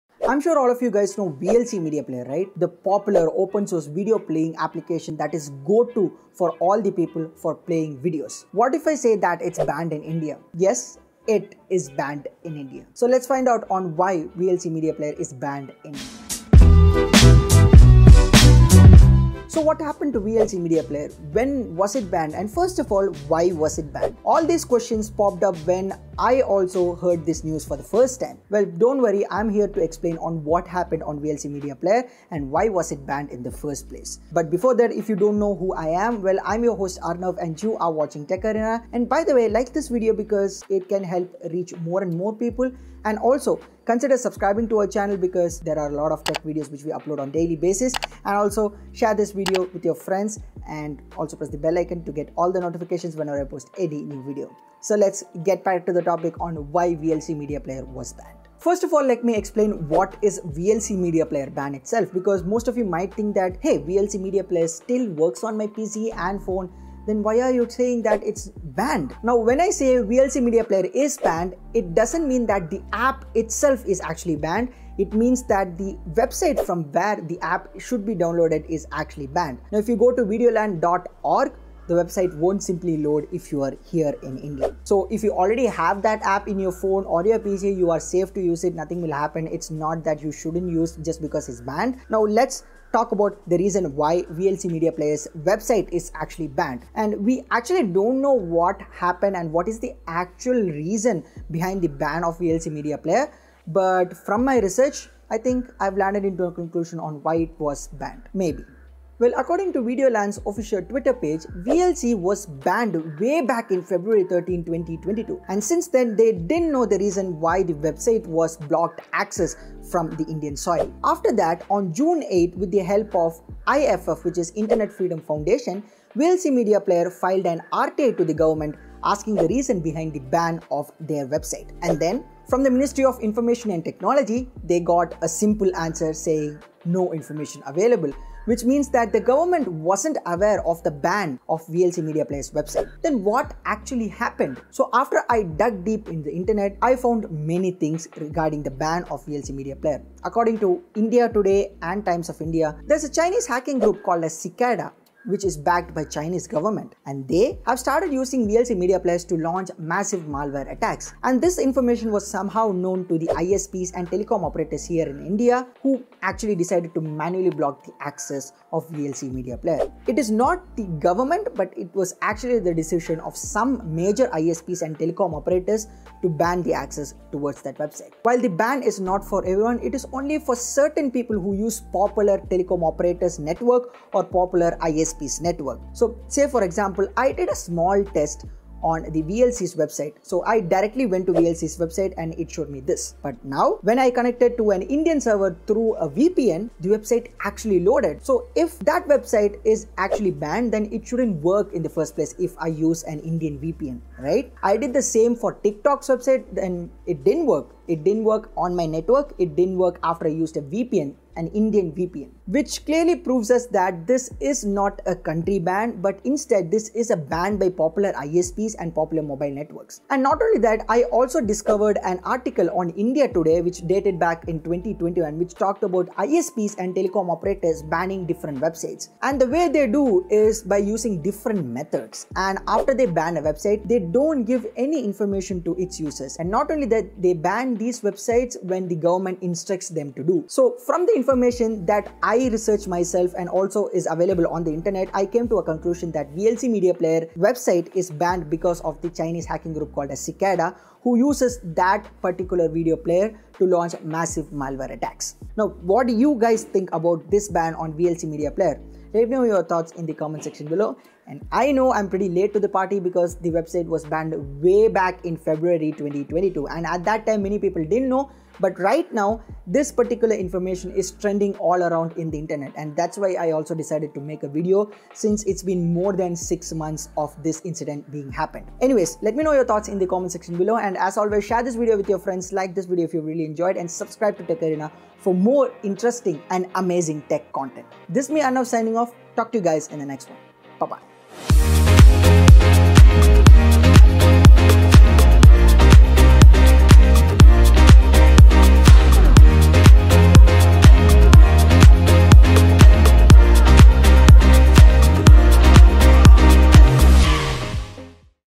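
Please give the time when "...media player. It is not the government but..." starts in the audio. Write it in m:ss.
2:49.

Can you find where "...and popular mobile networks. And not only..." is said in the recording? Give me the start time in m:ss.
3:38.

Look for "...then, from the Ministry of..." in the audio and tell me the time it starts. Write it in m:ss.
2:11.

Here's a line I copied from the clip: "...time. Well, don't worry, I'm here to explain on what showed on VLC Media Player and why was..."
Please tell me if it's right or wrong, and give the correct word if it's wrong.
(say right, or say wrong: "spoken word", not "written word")
wrong: "happened", not "showed".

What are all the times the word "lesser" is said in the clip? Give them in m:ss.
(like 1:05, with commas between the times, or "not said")
not said.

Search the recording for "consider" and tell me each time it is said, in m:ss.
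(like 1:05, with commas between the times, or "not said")
0:43.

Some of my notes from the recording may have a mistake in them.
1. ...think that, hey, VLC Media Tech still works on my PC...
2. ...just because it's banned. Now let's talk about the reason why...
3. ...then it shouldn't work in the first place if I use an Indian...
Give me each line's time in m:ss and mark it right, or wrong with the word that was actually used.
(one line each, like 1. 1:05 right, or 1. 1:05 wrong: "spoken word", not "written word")
1. 1:03 wrong: "Player", not "Tech"
2. 1:30 right
3. 3:20 right.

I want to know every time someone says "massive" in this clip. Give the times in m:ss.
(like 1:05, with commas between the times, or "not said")
2:39, 4:14.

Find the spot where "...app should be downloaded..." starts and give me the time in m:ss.
1:17.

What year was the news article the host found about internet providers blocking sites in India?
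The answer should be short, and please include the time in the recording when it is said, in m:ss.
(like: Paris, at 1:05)
2021, at 3:44.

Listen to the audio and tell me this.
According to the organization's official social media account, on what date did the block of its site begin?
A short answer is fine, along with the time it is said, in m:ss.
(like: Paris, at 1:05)
February 13, 2022, at 1:53.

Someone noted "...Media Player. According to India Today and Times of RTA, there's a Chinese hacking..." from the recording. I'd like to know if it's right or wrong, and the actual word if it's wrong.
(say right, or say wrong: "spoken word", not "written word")
wrong: "India", not "RTA".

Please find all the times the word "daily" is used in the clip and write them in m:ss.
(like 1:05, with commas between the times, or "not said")
0:47.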